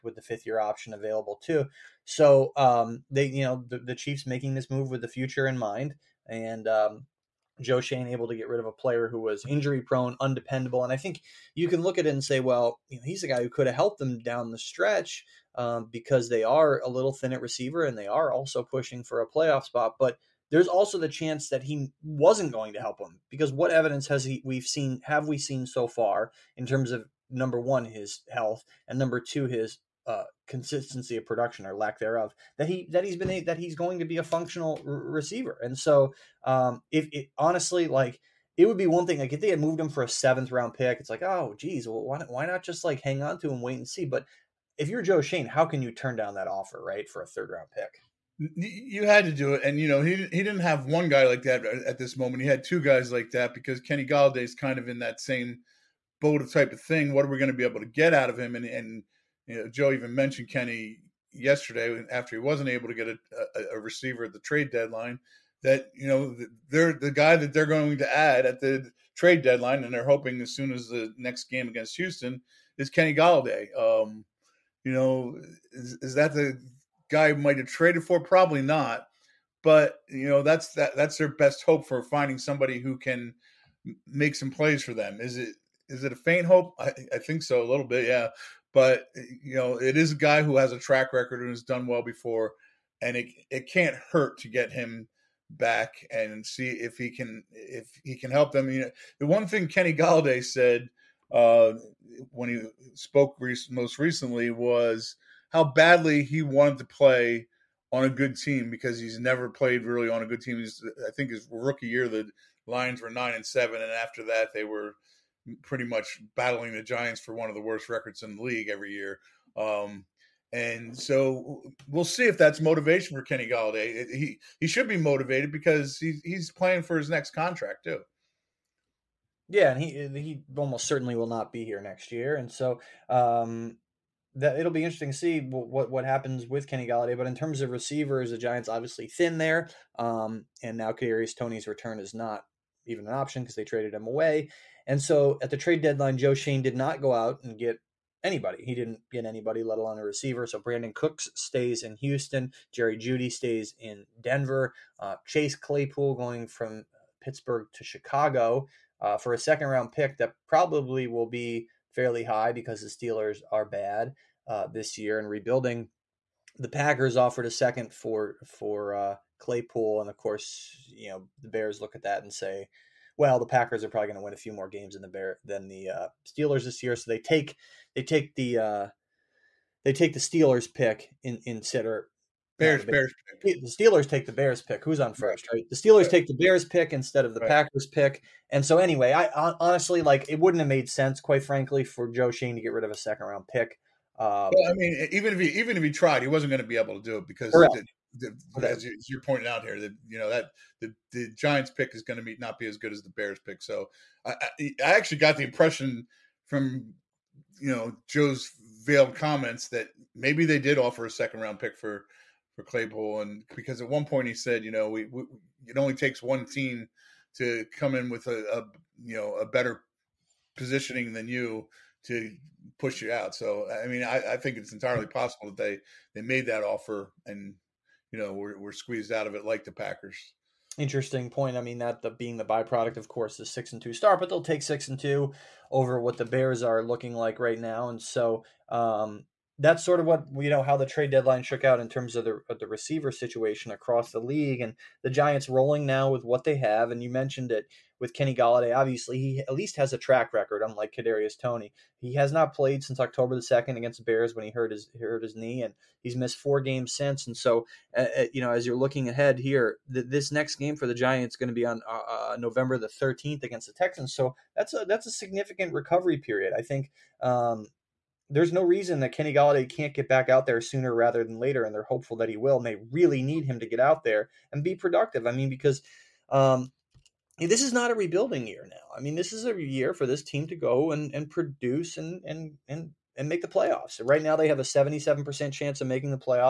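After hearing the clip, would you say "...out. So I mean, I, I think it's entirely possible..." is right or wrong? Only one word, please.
right.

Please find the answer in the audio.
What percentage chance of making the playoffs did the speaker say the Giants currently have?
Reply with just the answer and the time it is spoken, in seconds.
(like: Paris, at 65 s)
77%, at 284 s.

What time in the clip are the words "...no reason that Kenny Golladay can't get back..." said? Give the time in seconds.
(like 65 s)
268 s.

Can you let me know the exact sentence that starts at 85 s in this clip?
Is it is it a faint hope?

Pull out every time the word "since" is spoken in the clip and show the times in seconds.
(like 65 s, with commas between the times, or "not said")
252 s, 256 s.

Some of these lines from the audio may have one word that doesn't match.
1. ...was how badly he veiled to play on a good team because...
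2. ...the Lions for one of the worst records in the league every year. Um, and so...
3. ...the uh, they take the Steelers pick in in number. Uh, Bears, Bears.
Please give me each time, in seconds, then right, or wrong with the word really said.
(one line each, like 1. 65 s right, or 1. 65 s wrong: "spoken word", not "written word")
1. 104 s wrong: "wanted", not "veiled"
2. 116 s wrong: "Giants", not "Lions"
3. 178 s wrong: "sitter", not "number".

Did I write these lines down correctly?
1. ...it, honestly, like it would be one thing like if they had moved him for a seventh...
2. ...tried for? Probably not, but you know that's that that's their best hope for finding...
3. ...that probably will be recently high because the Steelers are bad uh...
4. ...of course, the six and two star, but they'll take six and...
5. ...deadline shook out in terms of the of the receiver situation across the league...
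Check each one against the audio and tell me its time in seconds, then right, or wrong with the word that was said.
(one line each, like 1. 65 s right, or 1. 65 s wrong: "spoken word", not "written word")
1. 37 s right
2. 77 s wrong: "traded", not "tried"
3. 160 s wrong: "fairly", not "recently"
4. 232 s right
5. 241 s right.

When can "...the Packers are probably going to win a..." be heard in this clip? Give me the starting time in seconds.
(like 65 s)
173 s.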